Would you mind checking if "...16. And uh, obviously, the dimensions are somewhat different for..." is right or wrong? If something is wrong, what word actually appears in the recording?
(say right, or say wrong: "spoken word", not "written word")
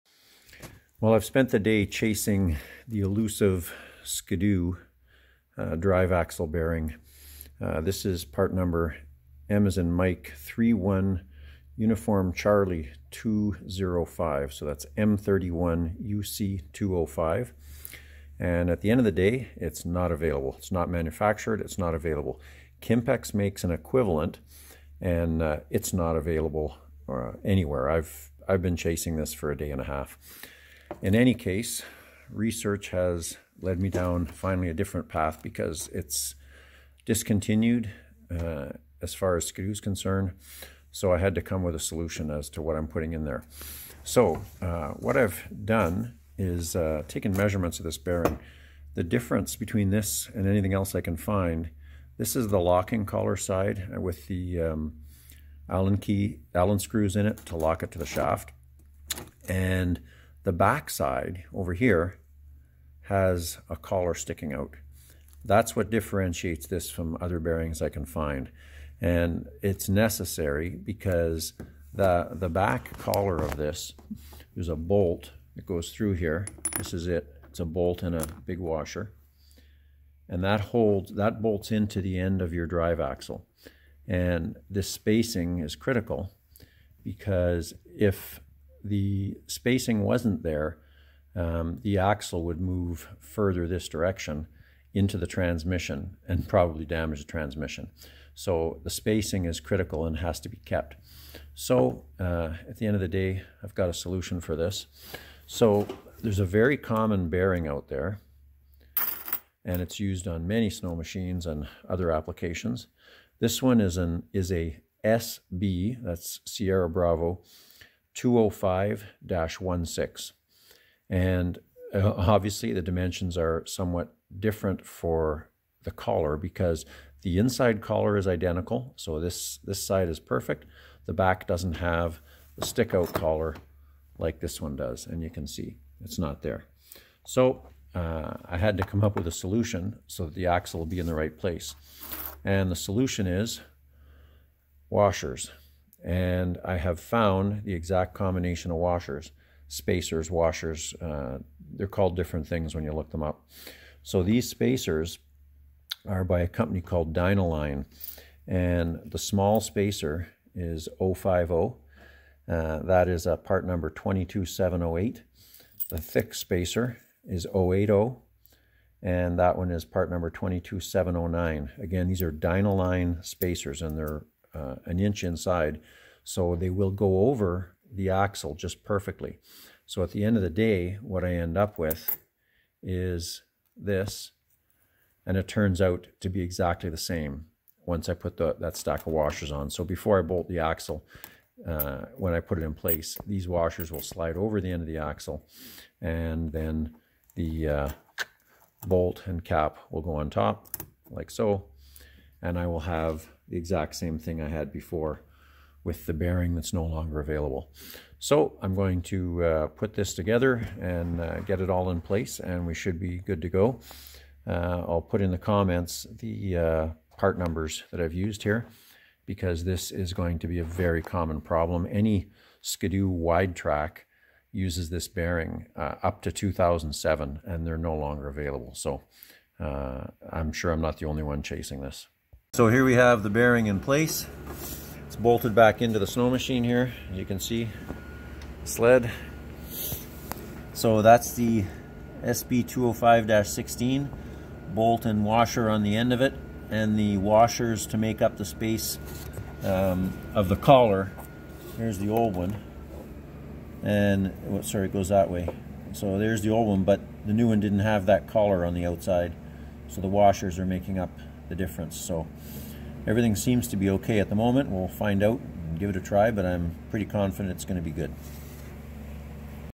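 right.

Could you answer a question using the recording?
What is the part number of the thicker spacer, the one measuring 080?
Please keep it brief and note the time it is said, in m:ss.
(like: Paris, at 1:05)
22709, at 2:50.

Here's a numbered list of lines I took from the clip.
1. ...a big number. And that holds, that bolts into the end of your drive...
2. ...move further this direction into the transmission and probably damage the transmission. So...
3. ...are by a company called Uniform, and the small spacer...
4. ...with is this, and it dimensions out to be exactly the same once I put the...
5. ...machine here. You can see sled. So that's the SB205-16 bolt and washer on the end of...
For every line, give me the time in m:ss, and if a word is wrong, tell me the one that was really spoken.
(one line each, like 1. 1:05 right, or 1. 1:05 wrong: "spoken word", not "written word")
1. 1:18 wrong: "washer", not "number"
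2. 1:32 right
3. 2:36 wrong: "Dynaline", not "Uniform"
4. 3:01 wrong: "turns", not "dimensions"
5. 3:56 right.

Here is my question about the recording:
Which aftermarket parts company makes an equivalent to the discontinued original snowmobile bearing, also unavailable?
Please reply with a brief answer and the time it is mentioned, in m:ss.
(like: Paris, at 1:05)
Kimpex, at 0:22.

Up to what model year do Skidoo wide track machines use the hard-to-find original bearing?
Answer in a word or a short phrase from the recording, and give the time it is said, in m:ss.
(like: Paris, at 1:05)
2007, at 3:46.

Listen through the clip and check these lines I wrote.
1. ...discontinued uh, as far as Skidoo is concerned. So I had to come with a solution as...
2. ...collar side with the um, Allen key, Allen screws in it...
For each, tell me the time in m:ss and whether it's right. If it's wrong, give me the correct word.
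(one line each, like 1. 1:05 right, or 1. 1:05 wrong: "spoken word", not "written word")
1. 0:37 right
2. 0:53 right.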